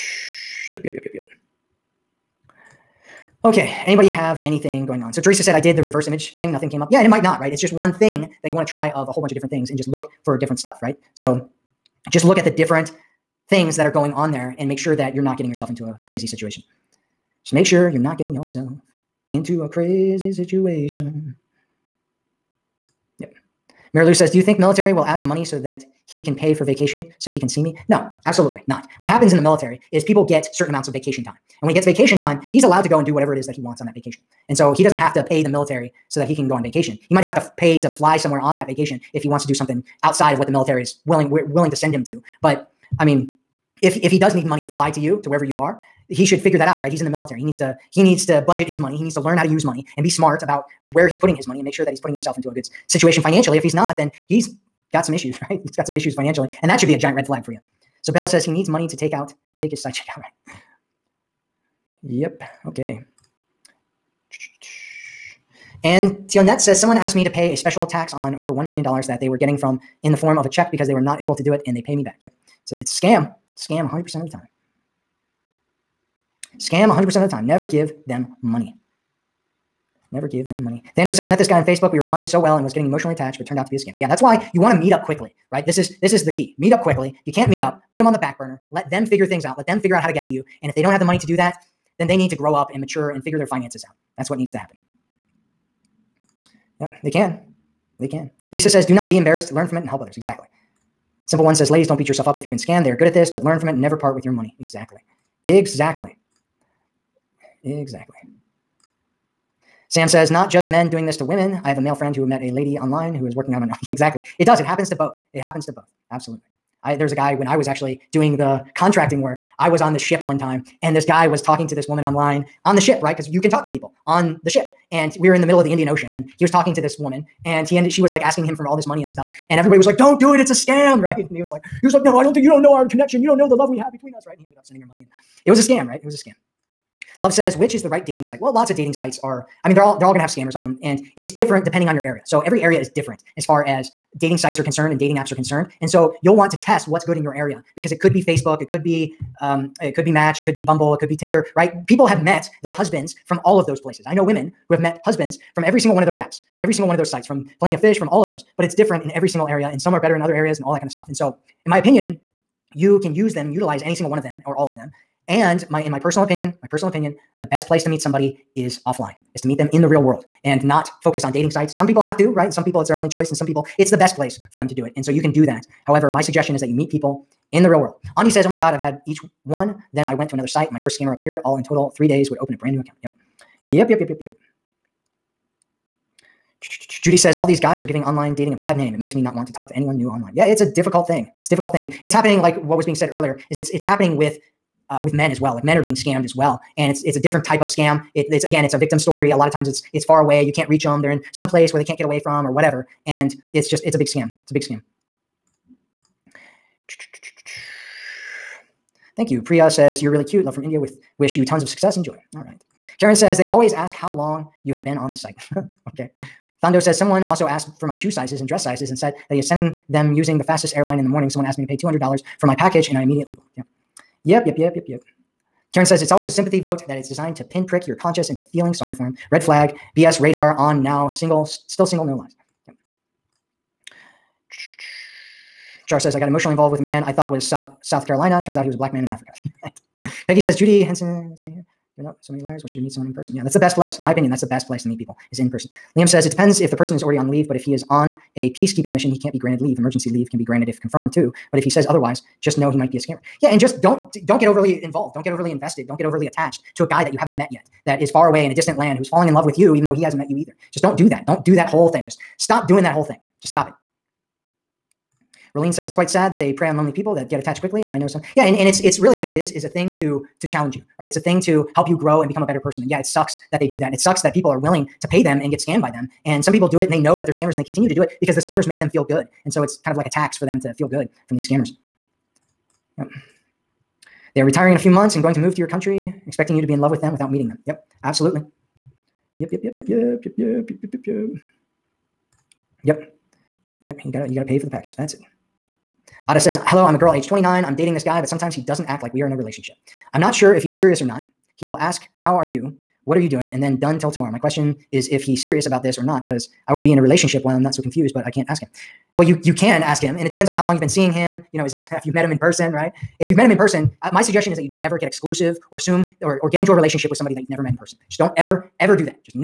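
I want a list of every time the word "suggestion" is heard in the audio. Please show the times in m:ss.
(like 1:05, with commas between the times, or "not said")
2:56, 5:14.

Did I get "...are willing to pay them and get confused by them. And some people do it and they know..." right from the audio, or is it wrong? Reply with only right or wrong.
wrong.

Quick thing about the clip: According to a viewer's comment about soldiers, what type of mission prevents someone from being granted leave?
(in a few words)
peacekeeping mission.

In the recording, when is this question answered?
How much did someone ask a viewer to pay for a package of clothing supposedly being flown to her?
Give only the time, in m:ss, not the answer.
3:41.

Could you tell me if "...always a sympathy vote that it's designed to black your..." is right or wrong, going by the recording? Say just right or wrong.
wrong.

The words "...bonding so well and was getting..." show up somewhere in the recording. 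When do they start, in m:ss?
1:22.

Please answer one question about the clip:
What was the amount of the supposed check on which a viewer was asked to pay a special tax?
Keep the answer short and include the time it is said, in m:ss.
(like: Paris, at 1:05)
$1 million, at 1:08.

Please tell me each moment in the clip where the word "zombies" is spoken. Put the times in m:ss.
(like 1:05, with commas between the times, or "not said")
not said.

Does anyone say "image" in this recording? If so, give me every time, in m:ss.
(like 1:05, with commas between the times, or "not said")
0:06.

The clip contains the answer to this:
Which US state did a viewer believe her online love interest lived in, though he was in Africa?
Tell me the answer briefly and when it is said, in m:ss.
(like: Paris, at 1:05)
South Carolina, at 3:57.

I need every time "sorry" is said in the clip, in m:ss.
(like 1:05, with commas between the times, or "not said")
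3:48.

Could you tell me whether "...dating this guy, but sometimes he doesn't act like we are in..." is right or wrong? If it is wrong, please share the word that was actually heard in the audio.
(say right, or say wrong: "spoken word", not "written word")
right.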